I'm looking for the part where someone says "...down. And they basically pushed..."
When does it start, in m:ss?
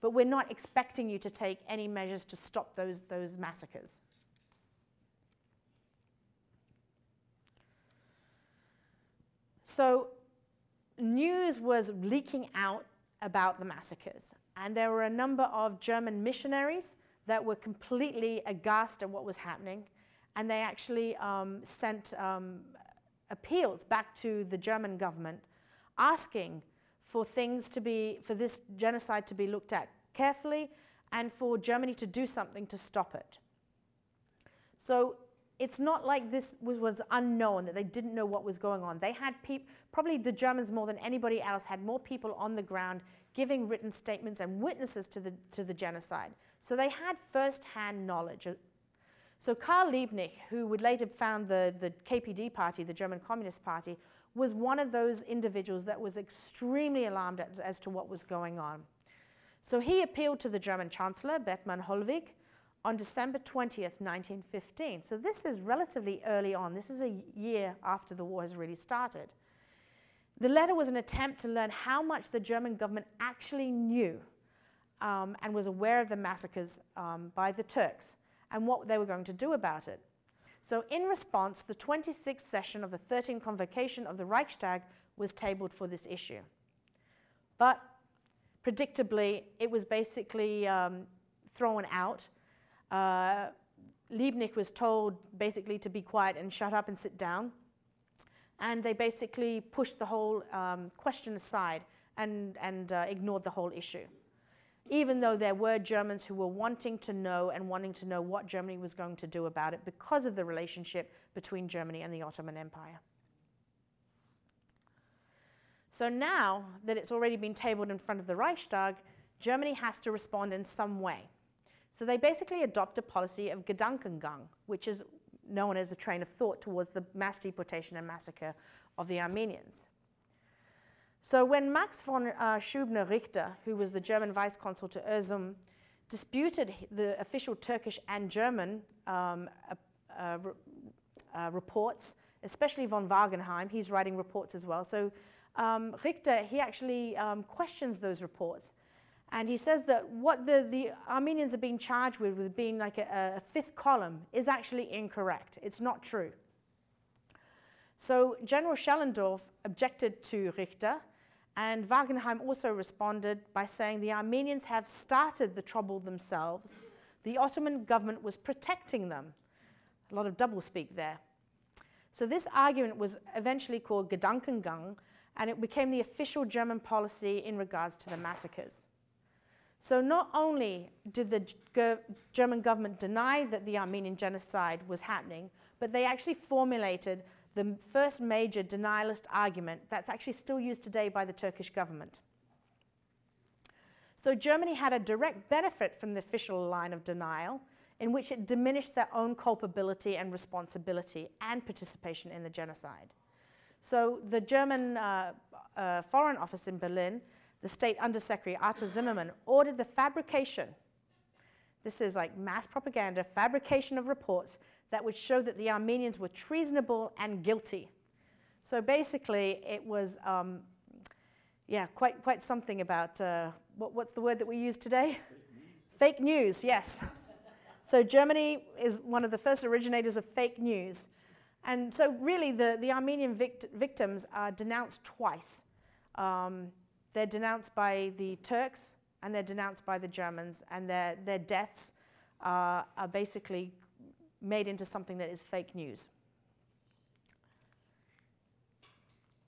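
1:37.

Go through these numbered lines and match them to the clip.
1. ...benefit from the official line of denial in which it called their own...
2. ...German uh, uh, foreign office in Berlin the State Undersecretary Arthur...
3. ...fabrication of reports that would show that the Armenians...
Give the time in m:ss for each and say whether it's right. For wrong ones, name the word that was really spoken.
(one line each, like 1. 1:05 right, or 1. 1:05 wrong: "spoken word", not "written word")
1. 3:15 wrong: "diminished", not "called"
2. 3:24 right
3. 3:33 right.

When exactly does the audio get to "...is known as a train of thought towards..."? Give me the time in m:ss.
2:04.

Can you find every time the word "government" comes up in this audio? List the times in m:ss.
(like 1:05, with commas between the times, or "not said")
0:24, 1:12, 2:47, 3:02, 3:11.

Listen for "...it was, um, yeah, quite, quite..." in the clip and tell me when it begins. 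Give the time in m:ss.
3:39.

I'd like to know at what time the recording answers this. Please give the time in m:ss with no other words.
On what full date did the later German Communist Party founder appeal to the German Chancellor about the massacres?
1:02.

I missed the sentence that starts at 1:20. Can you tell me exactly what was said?
So in response, the 26th session of the 13th convocation of the Reichstag was tabled for this issue.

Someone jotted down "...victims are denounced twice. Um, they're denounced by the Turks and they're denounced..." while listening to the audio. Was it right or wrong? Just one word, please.
right.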